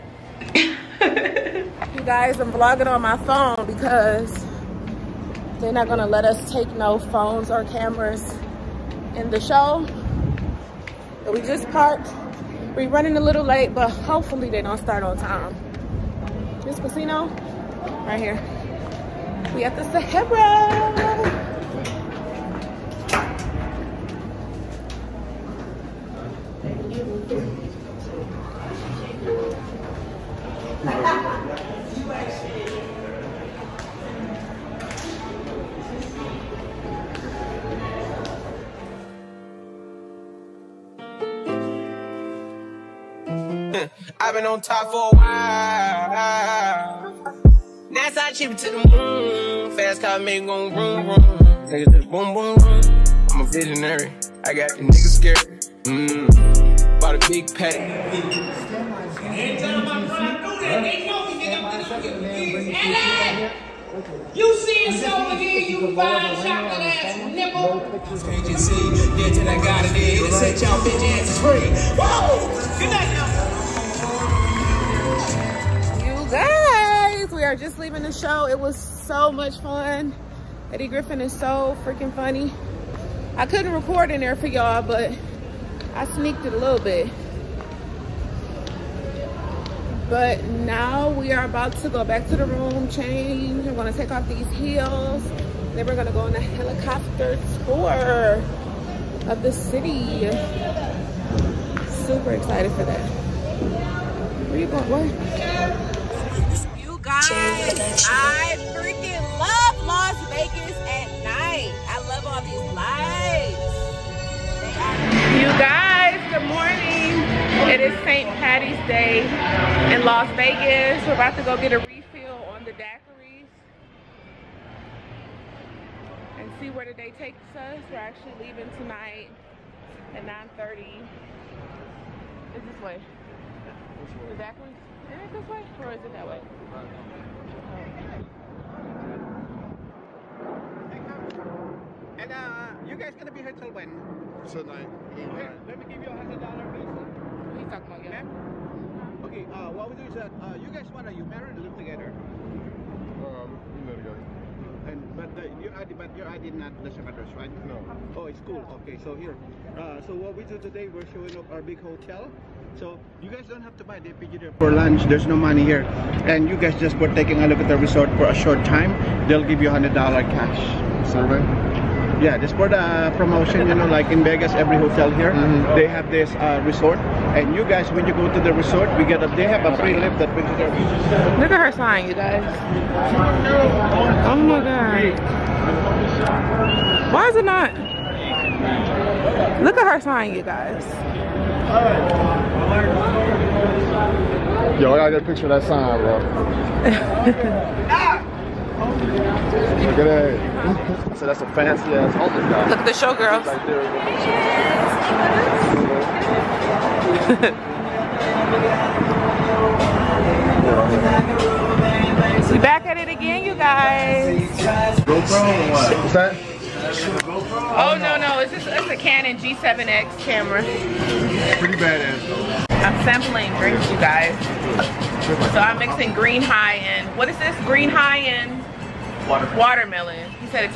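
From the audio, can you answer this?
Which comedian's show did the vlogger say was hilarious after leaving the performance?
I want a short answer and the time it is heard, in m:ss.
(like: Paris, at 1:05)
Eddie Griffin, at 1:20.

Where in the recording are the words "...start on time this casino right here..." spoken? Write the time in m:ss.
0:14.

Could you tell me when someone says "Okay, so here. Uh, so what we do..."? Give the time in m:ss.
2:38.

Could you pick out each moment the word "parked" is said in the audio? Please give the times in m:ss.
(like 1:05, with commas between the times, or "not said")
0:11.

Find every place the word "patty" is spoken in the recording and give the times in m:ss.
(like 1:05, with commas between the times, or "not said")
0:57, 1:58.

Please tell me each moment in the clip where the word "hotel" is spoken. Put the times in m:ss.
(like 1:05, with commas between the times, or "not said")
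2:41, 2:54.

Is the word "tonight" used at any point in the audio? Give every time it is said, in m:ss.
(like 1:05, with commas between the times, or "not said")
2:08, 2:24.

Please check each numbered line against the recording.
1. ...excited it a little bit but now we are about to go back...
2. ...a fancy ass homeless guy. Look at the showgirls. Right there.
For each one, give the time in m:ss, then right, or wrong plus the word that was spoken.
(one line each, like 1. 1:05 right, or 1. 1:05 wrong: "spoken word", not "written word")
1. 1:26 wrong: "sneaked", not "excited"
2. 3:21 right.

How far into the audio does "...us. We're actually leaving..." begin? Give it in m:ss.
2:07.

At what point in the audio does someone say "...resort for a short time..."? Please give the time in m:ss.
2:47.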